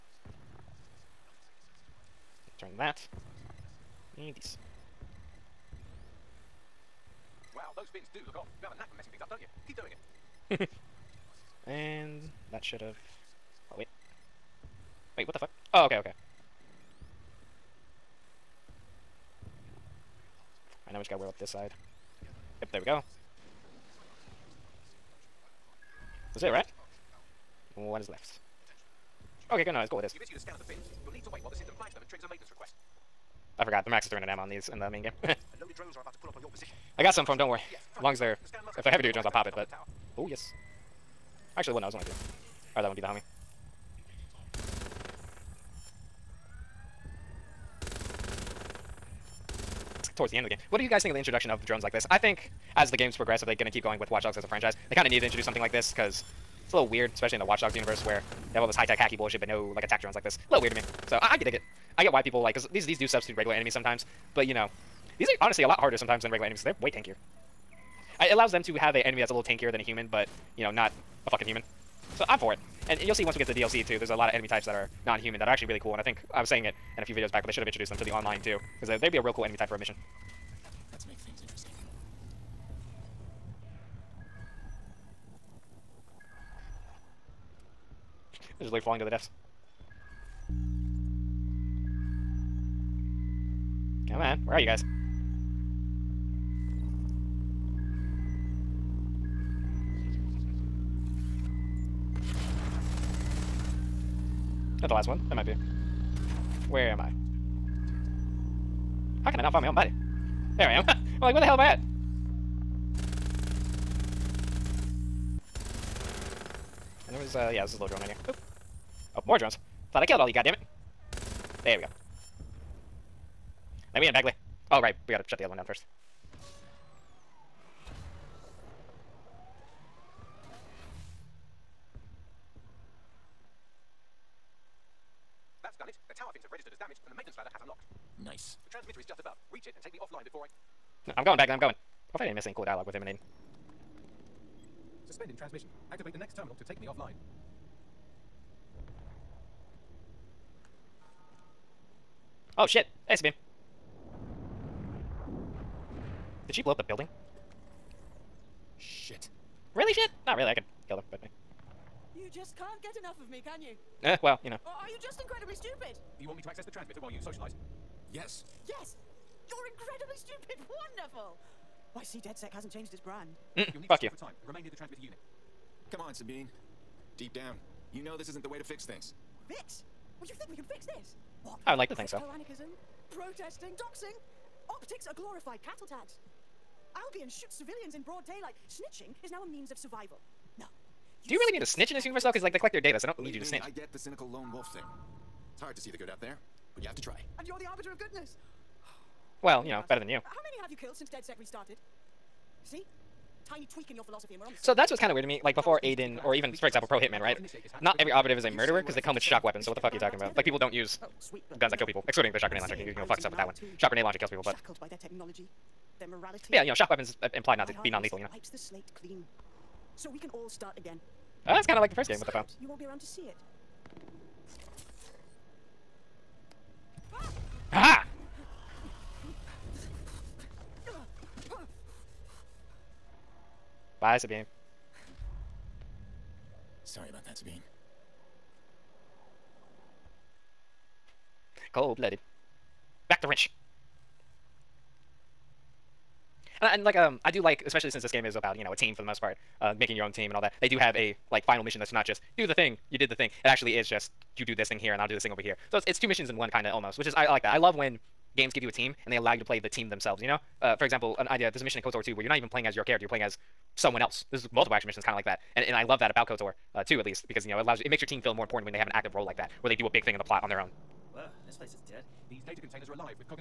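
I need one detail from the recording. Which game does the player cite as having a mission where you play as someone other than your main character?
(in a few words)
KOTOR 2.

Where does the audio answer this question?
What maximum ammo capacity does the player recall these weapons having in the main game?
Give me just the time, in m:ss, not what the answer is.
0:34.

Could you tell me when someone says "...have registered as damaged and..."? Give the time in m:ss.
2:16.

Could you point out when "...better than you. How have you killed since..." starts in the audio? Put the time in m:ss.
3:19.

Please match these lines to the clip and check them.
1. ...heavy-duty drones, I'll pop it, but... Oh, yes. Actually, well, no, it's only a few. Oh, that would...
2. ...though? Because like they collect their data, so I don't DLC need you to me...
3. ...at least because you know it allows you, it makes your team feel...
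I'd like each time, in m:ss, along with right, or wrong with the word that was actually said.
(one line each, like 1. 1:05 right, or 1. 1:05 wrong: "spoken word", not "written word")
1. 0:38 right
2. 3:12 wrong: "Believe", not "DLC"
3. 4:26 right.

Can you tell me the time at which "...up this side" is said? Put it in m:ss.
0:21.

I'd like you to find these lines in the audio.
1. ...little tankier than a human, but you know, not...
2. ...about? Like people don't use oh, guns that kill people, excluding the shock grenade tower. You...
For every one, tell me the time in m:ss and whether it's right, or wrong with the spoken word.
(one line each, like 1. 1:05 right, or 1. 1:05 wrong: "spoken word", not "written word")
1. 1:09 right
2. 3:30 wrong: "launcher", not "tower".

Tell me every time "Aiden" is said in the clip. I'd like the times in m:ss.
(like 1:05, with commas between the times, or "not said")
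2:23, 3:25.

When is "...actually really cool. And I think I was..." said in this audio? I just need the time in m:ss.
1:15.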